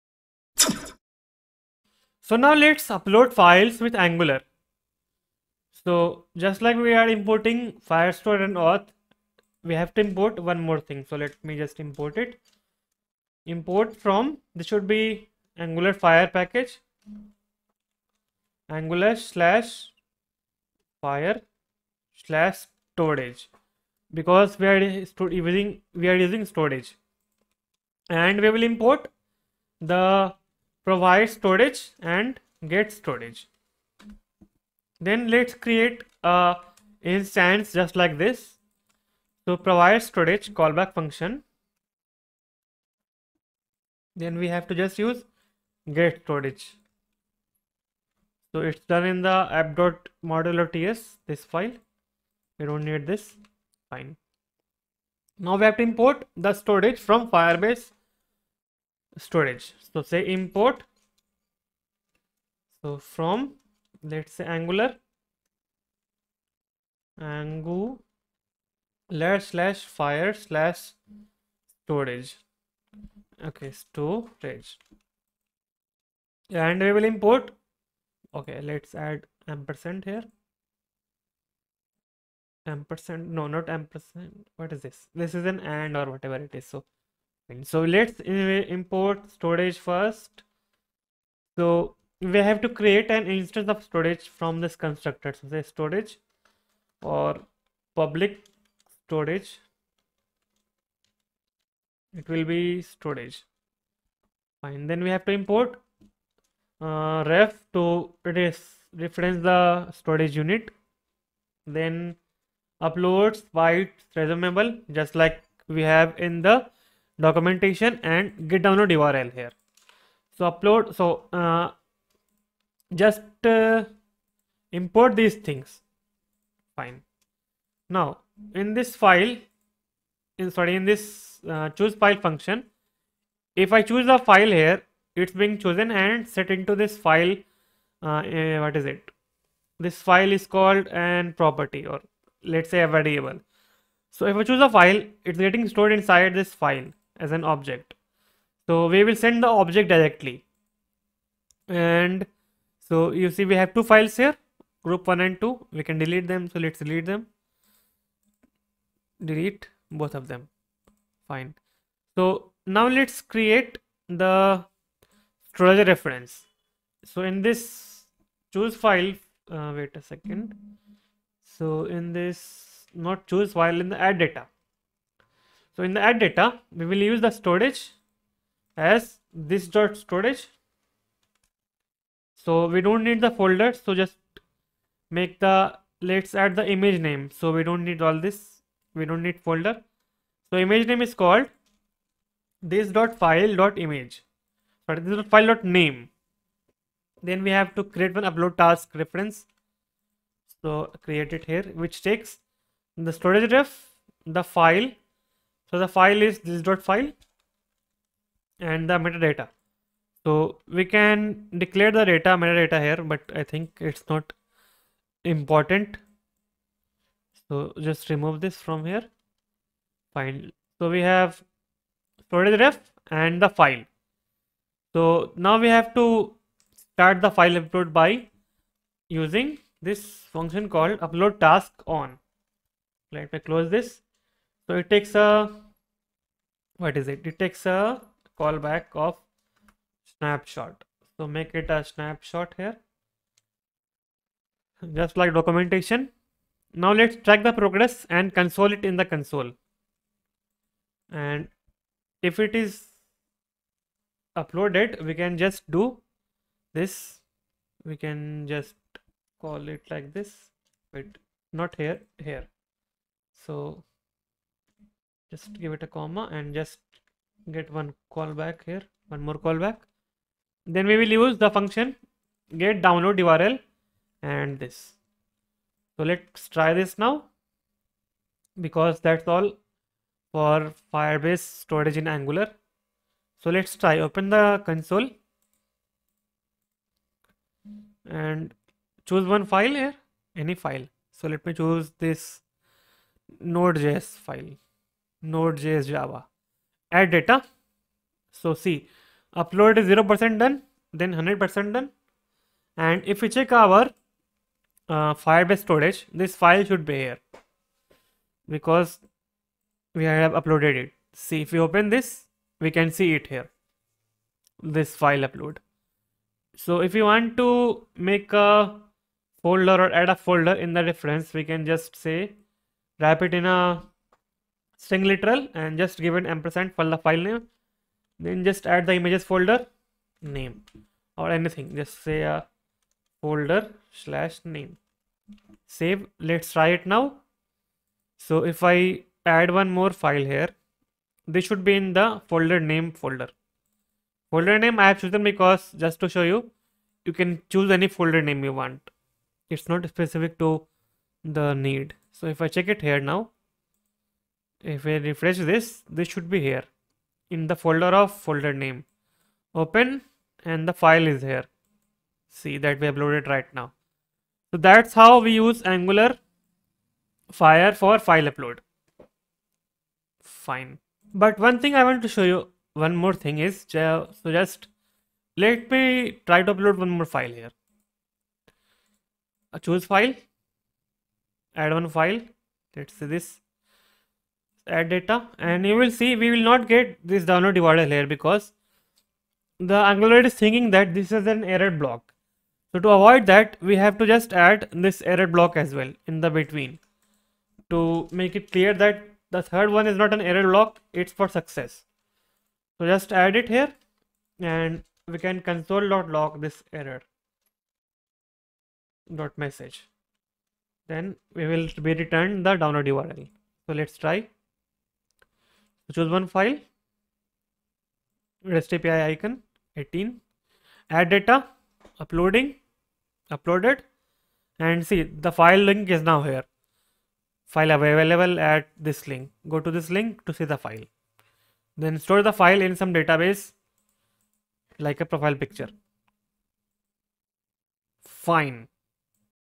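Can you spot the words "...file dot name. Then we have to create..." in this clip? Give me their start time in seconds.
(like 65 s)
195 s.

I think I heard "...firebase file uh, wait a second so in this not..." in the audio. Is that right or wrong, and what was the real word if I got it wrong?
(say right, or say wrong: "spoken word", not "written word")
wrong: "choose", not "firebase".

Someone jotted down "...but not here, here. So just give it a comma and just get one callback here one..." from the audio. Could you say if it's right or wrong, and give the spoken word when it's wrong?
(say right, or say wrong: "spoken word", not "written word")
right.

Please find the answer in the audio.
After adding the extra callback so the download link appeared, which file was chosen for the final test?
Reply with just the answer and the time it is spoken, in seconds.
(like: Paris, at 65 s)
REST API icon 18, at 418 s.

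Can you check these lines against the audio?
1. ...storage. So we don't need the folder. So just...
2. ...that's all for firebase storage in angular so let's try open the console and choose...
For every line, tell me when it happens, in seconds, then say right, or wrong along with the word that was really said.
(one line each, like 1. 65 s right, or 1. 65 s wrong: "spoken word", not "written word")
1. 179 s right
2. 279 s right.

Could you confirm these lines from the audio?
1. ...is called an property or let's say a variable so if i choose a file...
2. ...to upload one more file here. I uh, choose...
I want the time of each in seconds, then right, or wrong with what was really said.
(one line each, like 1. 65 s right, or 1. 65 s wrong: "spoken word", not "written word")
1. 140 s right
2. 376 s right.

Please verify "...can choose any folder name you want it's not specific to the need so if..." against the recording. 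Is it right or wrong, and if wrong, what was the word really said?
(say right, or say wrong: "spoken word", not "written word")
right.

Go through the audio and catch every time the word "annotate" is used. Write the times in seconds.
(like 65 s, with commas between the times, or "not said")
not said.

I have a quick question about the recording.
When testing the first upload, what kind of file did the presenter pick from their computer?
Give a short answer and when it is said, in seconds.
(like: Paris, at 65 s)
node.js file, at 293 s.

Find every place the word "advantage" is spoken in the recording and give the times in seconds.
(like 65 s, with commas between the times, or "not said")
not said.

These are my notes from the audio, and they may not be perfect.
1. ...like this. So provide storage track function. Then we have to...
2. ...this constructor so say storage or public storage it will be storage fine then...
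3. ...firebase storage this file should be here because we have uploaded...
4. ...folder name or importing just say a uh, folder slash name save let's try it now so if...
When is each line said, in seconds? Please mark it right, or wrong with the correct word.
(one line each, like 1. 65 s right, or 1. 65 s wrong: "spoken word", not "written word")
1. 37 s wrong: "callback", not "track"
2. 94 s right
3. 305 s right
4. 329 s wrong: "anything", not "importing".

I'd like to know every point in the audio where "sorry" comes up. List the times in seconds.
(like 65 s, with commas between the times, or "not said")
130 s, 194 s.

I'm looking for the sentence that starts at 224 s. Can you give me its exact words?
So now we have to start the file upload by using this function called upload task on.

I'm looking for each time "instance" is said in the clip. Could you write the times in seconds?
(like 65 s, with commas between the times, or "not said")
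37 s, 93 s.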